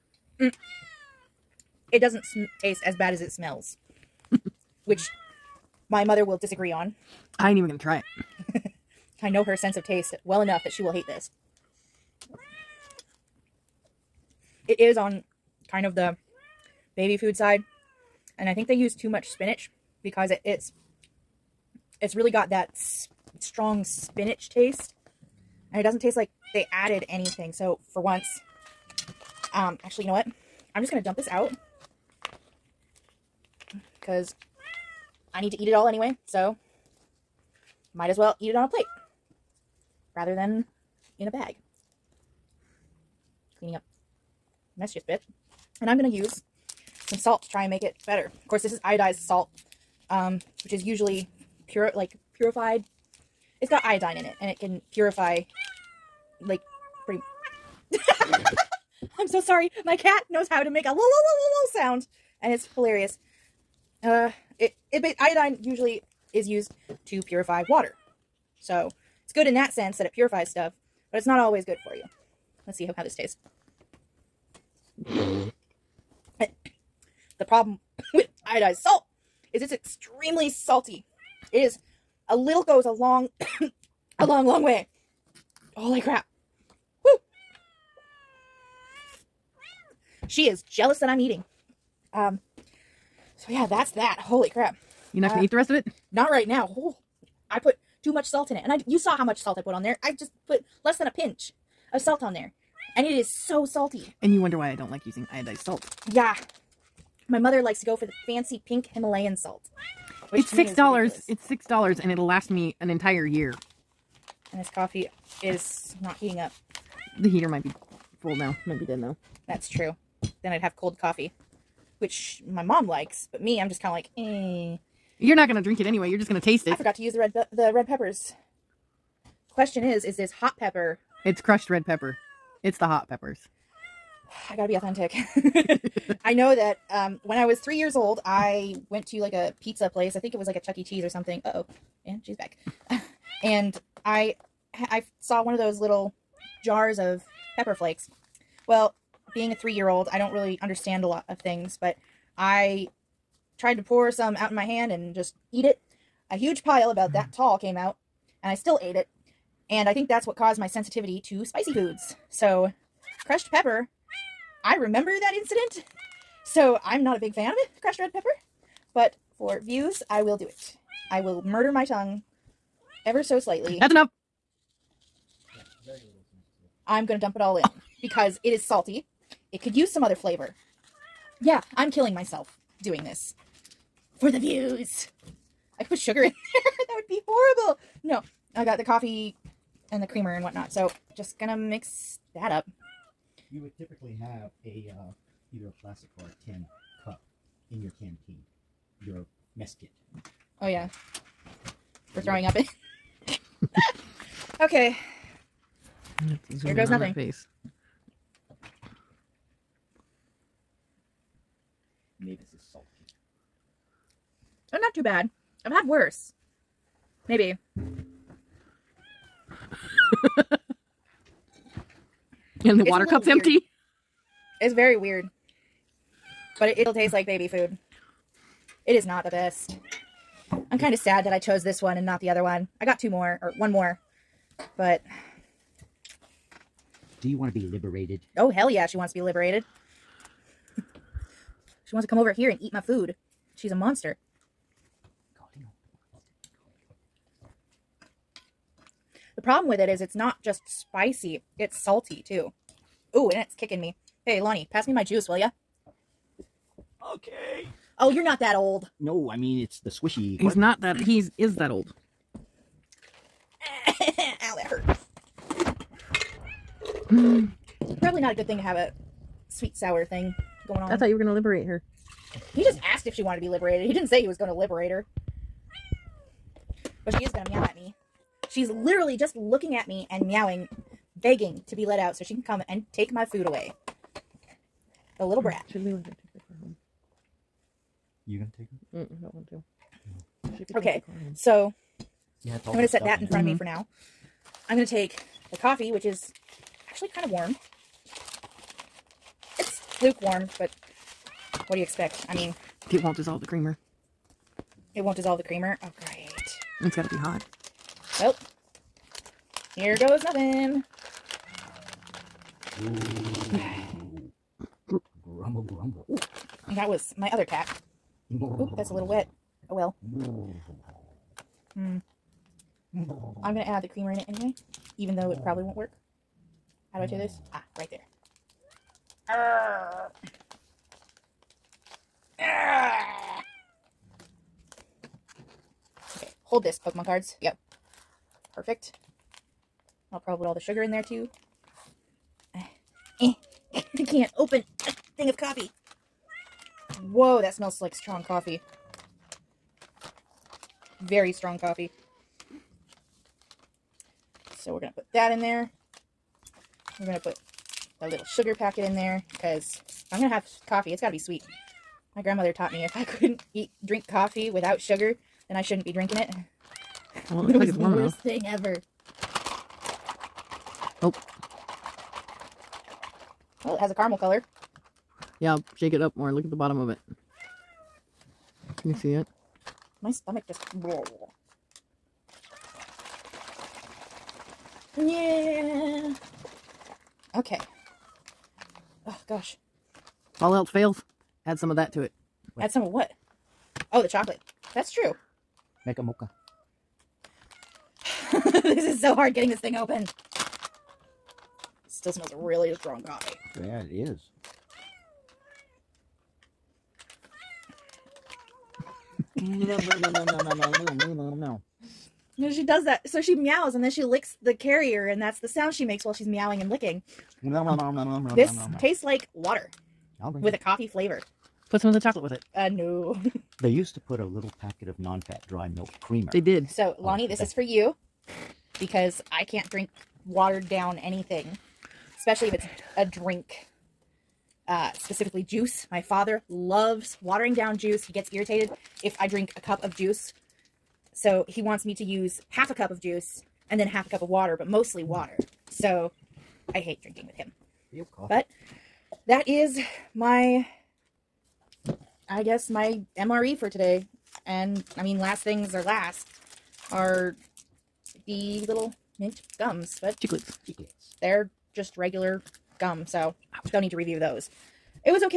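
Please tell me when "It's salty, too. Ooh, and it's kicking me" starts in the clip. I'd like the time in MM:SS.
04:11.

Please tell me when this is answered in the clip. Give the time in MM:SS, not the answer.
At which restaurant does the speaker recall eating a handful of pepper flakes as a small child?
02:20.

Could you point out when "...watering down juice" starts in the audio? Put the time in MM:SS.
07:17.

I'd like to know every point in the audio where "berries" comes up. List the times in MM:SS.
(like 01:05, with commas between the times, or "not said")
not said.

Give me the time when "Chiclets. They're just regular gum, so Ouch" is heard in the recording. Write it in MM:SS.
07:40.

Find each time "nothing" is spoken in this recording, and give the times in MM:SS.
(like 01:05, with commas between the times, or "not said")
03:26, 05:10.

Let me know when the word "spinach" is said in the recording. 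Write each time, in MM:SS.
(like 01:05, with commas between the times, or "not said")
00:19, 00:23.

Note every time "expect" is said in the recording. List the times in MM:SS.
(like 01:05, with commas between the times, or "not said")
05:01.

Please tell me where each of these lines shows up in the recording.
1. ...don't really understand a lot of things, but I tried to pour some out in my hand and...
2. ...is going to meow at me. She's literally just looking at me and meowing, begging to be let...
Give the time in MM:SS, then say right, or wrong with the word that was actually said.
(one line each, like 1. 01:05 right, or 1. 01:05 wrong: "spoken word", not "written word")
1. 02:30 right
2. 04:37 right.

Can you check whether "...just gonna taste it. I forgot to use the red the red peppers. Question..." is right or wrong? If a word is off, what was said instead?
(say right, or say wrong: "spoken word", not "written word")
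right.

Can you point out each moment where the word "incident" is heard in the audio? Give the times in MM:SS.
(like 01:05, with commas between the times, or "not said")
02:45.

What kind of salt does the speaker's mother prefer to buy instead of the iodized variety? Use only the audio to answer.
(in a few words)
pink Himalayan salt.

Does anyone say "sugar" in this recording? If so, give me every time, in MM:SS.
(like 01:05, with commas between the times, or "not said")
03:05, 05:40, 05:58, 06:04.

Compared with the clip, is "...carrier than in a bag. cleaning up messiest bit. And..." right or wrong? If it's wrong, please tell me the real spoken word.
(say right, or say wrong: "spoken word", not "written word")
wrong: "rather", not "carrier".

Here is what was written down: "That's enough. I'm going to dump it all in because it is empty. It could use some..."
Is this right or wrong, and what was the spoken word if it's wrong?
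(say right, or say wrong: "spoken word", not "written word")
wrong: "salty", not "empty".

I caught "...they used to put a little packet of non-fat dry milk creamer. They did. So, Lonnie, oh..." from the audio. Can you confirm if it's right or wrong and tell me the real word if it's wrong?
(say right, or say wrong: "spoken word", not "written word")
right.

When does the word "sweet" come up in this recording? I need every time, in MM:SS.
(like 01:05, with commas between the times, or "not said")
04:29, 06:01.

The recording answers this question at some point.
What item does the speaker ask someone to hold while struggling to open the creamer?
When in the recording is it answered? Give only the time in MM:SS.
05:36.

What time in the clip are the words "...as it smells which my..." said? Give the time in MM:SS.
00:03.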